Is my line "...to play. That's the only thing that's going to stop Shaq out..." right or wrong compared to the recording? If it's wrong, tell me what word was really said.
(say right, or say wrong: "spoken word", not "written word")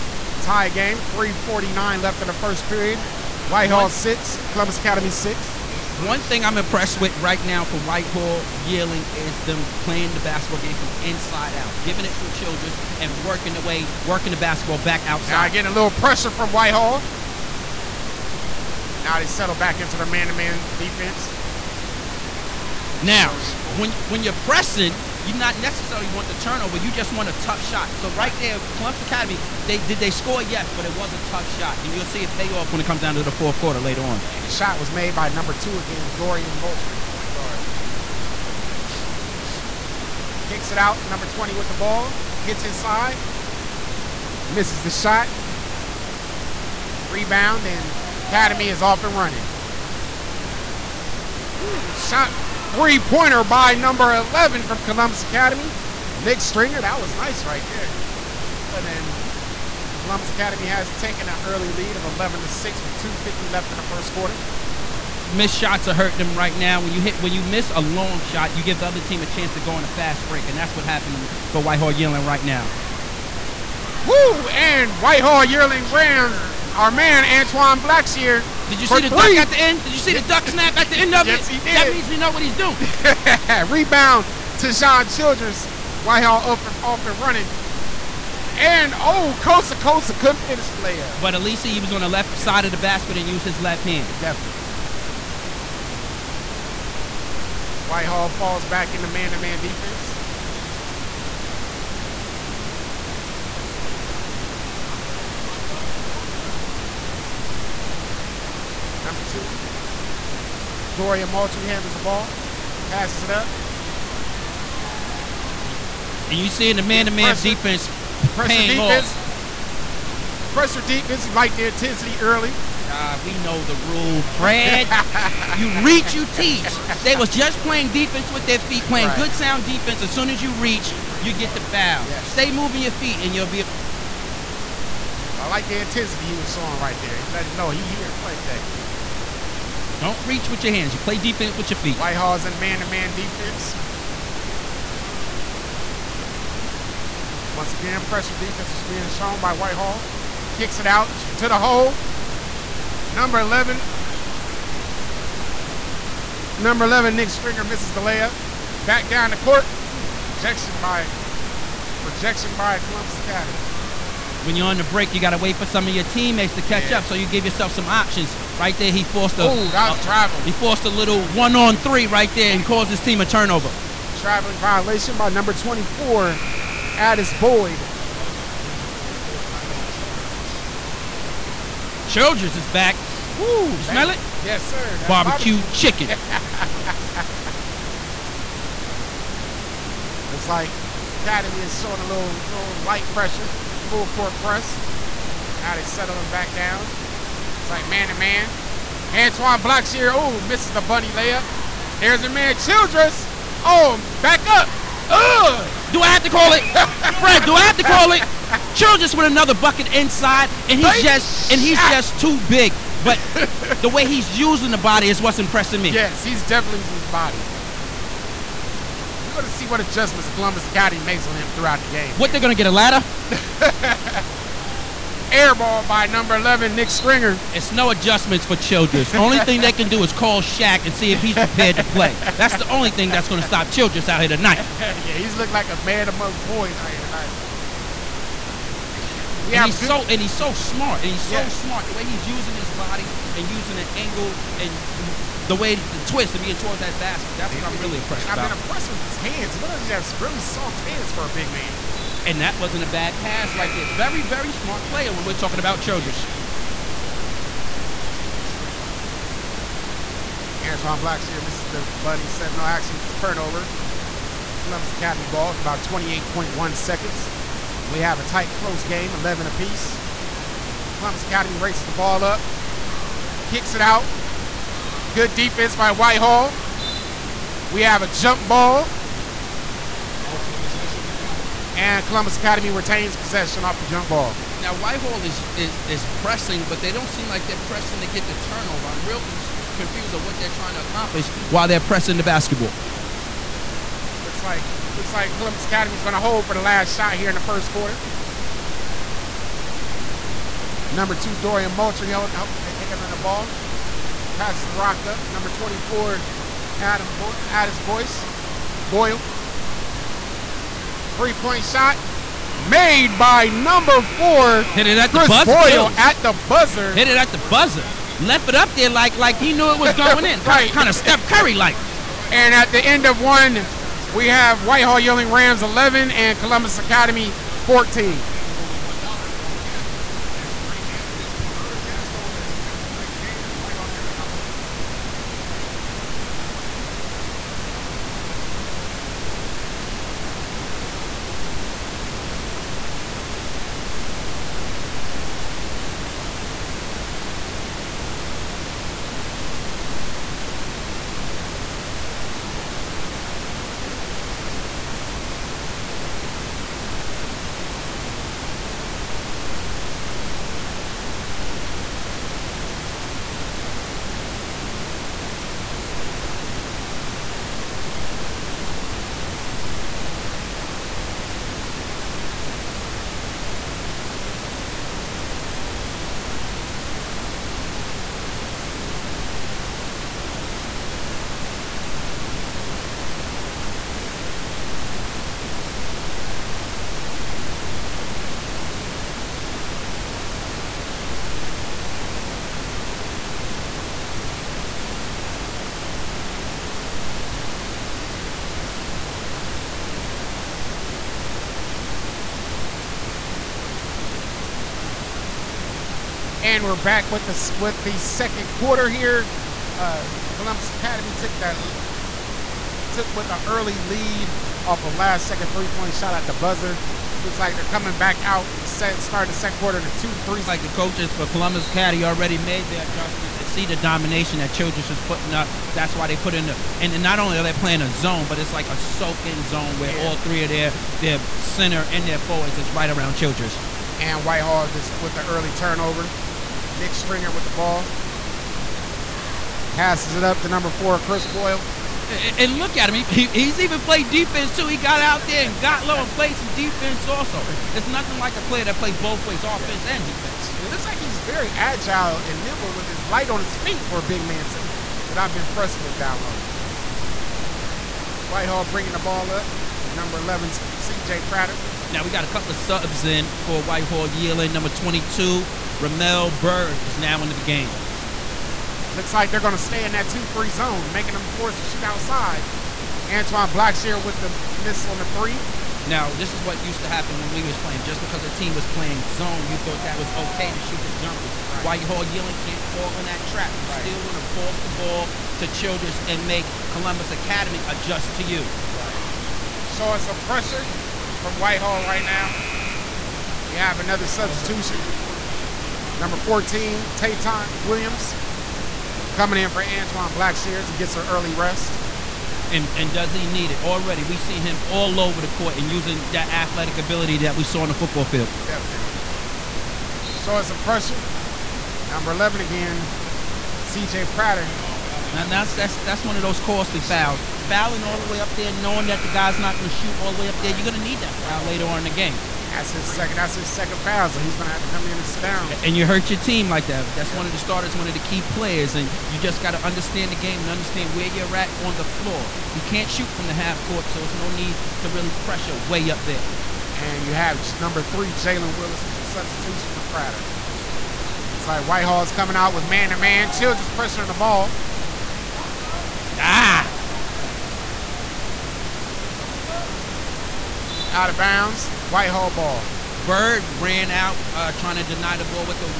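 wrong: "Childress", not "Shaq".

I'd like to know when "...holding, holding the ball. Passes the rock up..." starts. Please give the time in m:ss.
5:02.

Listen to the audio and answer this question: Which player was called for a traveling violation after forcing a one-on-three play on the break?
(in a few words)
Addis Boyd.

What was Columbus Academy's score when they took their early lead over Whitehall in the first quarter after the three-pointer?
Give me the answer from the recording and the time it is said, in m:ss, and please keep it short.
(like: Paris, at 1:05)
11, at 1:02.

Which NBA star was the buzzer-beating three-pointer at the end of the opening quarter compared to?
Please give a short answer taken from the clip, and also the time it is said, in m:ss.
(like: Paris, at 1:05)
Steph Curry, at 5:20.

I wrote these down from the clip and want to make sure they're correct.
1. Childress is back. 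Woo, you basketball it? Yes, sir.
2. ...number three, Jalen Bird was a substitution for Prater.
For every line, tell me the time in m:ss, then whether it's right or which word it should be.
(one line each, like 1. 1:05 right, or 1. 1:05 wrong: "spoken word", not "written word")
1. 3:02 wrong: "smell", not "basketball"
2. 8:57 wrong: "Willis", not "Bird".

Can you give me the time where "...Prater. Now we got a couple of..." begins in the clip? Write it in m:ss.
7:41.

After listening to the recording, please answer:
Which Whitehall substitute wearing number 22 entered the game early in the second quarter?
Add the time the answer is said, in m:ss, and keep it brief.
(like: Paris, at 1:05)
Ramel Bird, at 7:45.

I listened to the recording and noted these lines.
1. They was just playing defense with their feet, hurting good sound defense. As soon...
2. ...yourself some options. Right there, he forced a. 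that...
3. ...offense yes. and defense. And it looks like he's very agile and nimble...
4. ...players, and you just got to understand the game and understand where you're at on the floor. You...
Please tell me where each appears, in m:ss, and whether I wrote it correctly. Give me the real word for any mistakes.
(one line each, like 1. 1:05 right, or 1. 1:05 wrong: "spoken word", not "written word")
1. 2:07 wrong: "playing", not "hurting"
2. 2:47 right
3. 7:29 right
4. 8:48 right.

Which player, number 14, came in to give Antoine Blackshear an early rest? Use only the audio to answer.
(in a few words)
Tayton Williams.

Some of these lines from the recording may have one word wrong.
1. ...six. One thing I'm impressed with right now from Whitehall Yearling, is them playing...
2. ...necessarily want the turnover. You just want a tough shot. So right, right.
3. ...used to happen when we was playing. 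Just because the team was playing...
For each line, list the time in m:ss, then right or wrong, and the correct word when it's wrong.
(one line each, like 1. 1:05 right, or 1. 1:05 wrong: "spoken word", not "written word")
1. 0:05 right
2. 0:25 right
3. 7:56 right.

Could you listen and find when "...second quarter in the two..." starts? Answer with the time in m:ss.
6:59.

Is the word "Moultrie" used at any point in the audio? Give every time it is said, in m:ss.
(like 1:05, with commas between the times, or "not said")
0:36, 1:51, 5:01.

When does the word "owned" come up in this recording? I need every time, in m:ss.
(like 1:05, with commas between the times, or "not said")
not said.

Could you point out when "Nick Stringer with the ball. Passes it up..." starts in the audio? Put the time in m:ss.
7:16.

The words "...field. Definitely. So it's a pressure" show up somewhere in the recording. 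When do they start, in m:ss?
8:28.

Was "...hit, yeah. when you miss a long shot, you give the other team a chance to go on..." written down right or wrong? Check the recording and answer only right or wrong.
right.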